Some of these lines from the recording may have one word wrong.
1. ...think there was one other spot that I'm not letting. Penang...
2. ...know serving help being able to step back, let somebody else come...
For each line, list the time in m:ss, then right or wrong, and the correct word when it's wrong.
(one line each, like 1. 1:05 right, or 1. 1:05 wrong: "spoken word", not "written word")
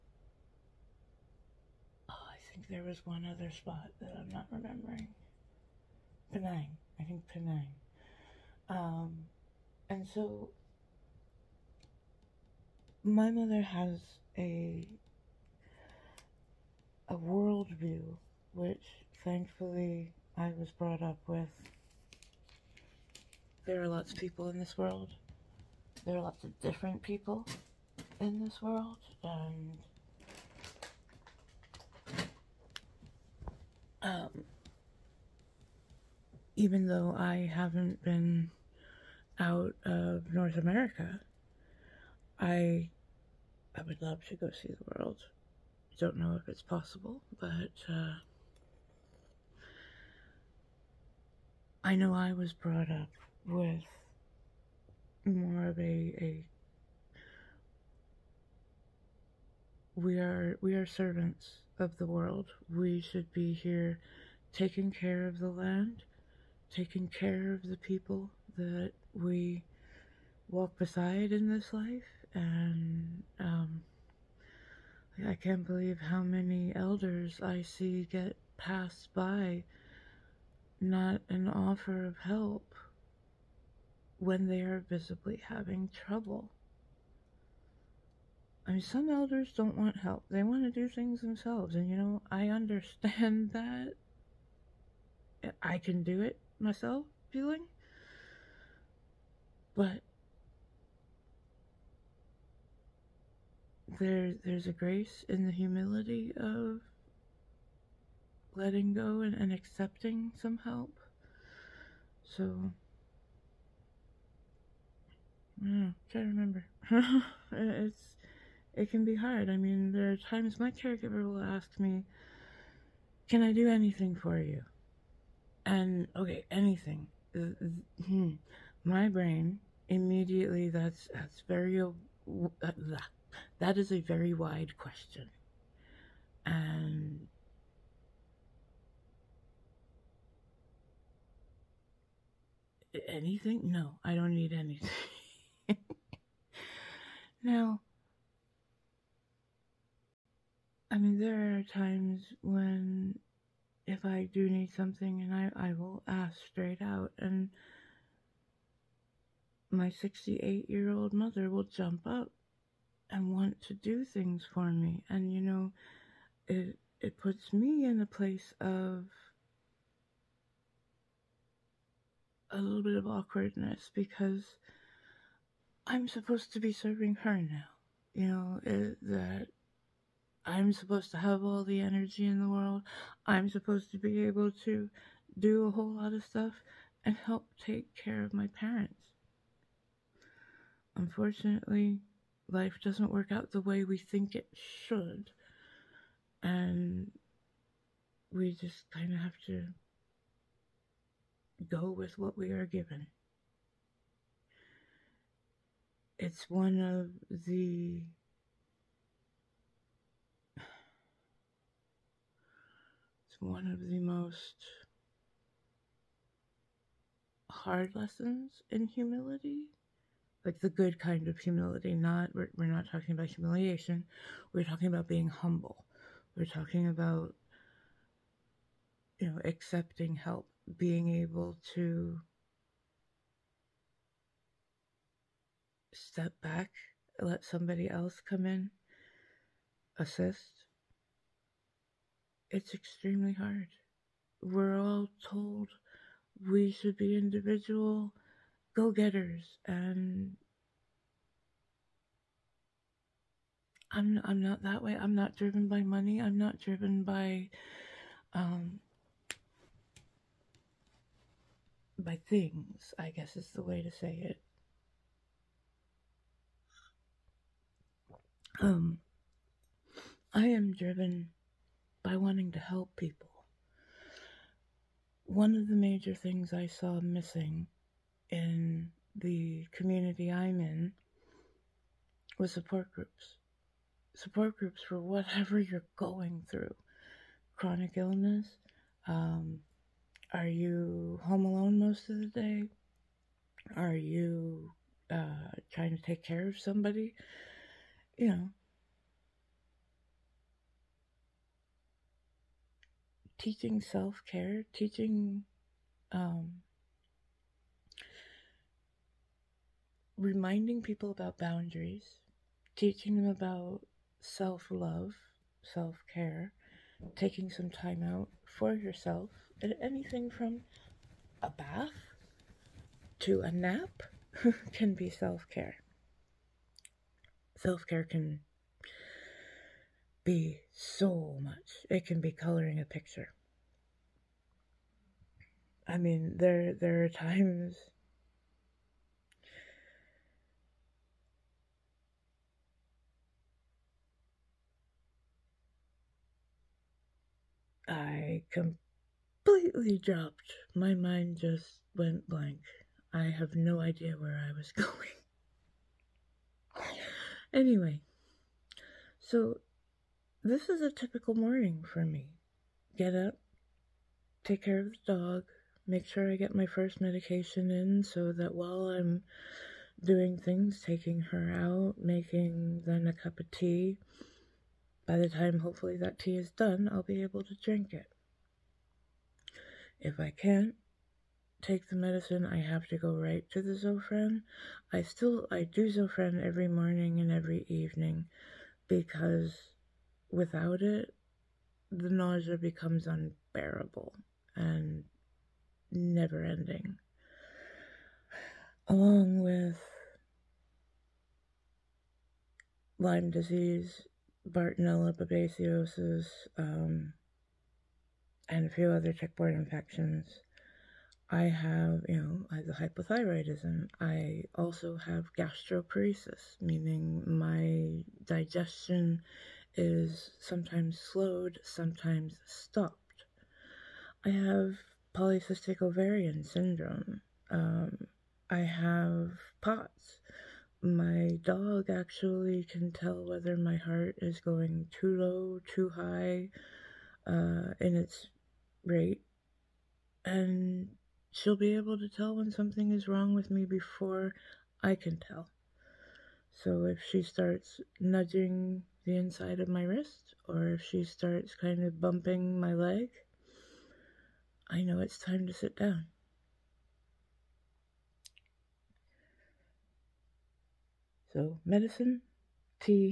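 1. 0:02 wrong: "remembering", not "letting"
2. 3:49 wrong: "accepting", not "serving".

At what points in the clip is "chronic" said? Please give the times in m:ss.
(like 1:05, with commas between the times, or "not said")
4:47.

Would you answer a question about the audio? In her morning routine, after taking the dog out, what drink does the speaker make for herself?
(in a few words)
A cup of tea.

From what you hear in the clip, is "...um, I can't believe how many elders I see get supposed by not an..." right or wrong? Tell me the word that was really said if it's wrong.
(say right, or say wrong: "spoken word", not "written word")
wrong: "passed", not "supposed".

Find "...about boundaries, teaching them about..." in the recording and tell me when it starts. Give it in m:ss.
5:11.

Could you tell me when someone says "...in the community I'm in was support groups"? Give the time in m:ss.
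4:38.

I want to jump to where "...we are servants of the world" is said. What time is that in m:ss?
1:00.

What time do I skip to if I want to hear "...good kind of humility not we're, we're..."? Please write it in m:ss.
3:40.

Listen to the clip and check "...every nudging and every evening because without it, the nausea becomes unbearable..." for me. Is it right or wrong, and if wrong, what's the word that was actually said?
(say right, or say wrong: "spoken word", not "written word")
wrong: "morning", not "nudging".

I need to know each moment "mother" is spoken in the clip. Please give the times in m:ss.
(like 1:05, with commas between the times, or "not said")
0:13, 2:41.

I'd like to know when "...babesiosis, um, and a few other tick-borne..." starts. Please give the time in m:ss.
6:45.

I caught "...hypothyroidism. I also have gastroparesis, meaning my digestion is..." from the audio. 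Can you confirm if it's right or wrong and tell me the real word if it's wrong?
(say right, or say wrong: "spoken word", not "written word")
right.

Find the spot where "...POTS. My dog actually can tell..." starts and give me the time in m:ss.
7:09.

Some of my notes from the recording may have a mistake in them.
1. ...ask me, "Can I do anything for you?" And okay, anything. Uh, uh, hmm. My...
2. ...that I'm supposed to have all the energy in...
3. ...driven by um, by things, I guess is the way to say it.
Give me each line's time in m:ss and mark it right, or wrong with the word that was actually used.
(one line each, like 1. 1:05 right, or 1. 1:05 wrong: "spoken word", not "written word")
1. 2:01 right
2. 2:59 right
3. 4:16 right.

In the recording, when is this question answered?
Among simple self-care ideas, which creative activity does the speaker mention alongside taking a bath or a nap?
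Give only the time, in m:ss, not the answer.
5:32.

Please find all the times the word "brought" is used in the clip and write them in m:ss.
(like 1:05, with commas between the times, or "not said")
0:20, 0:52.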